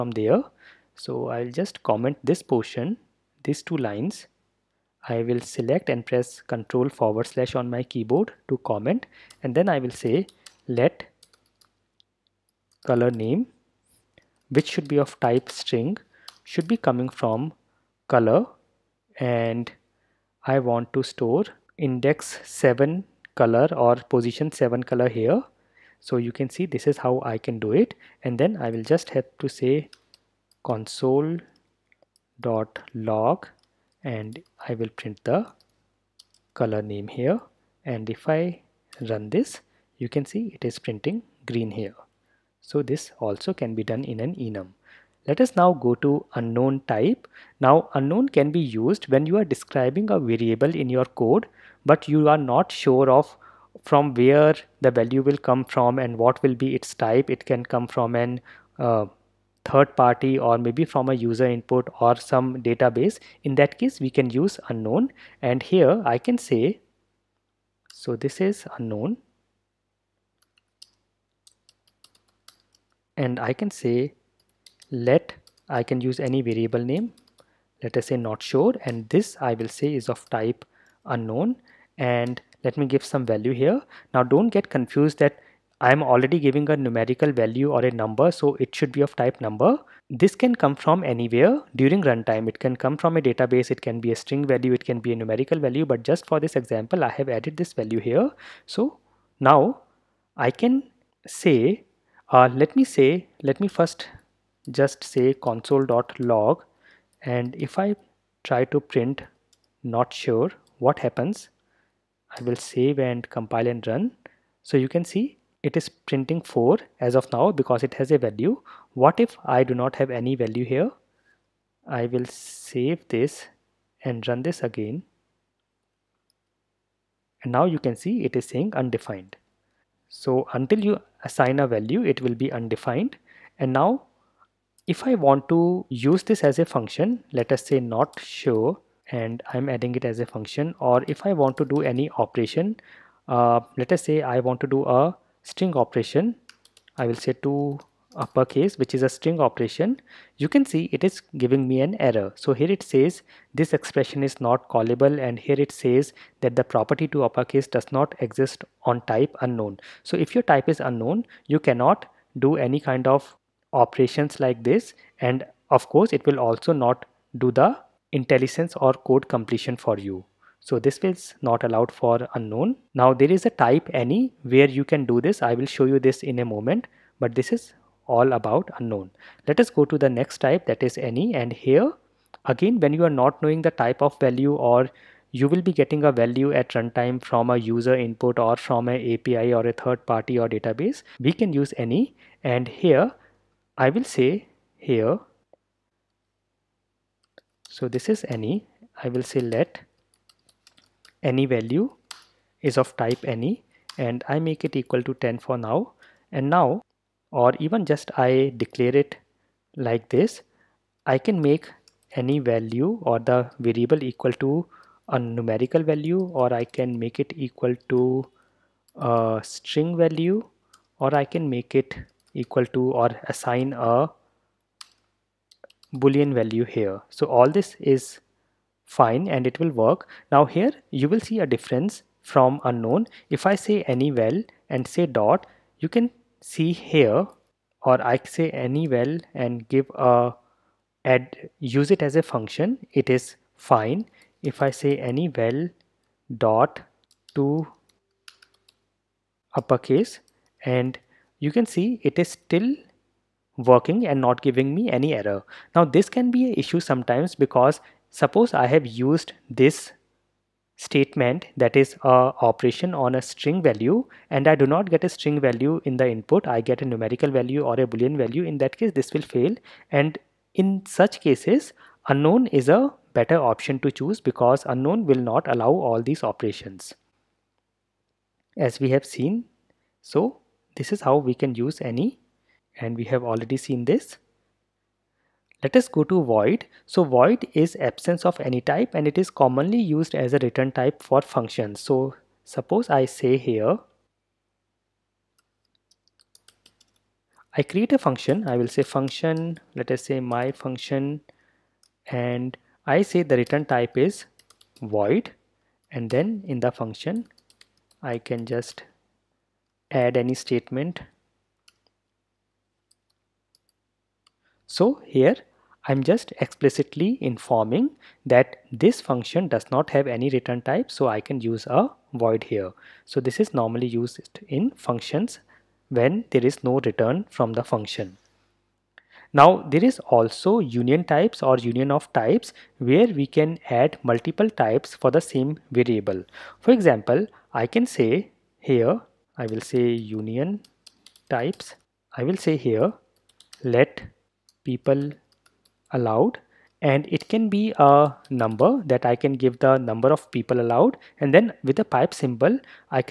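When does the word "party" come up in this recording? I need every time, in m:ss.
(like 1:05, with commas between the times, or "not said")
0:59, 3:10.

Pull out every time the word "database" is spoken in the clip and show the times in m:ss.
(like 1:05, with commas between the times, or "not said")
1:02, 1:33, 3:10.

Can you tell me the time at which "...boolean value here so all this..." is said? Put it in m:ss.
3:45.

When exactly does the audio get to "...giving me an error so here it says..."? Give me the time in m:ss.
2:31.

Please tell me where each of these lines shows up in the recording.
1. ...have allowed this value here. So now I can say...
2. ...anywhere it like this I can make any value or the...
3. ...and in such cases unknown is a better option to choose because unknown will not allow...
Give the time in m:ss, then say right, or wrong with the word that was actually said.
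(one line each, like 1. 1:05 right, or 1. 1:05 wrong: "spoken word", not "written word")
1. 1:37 wrong: "added", not "allowed"
2. 3:28 wrong: "declare", not "anywhere"
3. 4:29 right.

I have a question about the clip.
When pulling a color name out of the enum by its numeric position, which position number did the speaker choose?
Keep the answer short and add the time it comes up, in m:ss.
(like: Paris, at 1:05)
7, at 0:23.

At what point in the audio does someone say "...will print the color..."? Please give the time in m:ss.
0:34.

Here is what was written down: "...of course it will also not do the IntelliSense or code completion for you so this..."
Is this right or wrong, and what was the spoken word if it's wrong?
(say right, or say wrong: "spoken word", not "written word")
right.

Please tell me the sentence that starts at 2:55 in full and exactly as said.
I will show you this in a moment, but this is all about unknown.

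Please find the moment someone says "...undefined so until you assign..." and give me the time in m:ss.
2:08.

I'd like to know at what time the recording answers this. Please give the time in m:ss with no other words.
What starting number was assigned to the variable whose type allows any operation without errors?
3:25.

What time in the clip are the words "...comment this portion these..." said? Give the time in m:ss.
0:01.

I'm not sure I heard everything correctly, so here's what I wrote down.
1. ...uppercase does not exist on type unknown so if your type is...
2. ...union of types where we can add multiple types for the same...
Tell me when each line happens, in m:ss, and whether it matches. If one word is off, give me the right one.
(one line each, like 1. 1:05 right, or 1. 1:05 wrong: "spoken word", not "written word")
1. 2:37 right
2. 5:31 right.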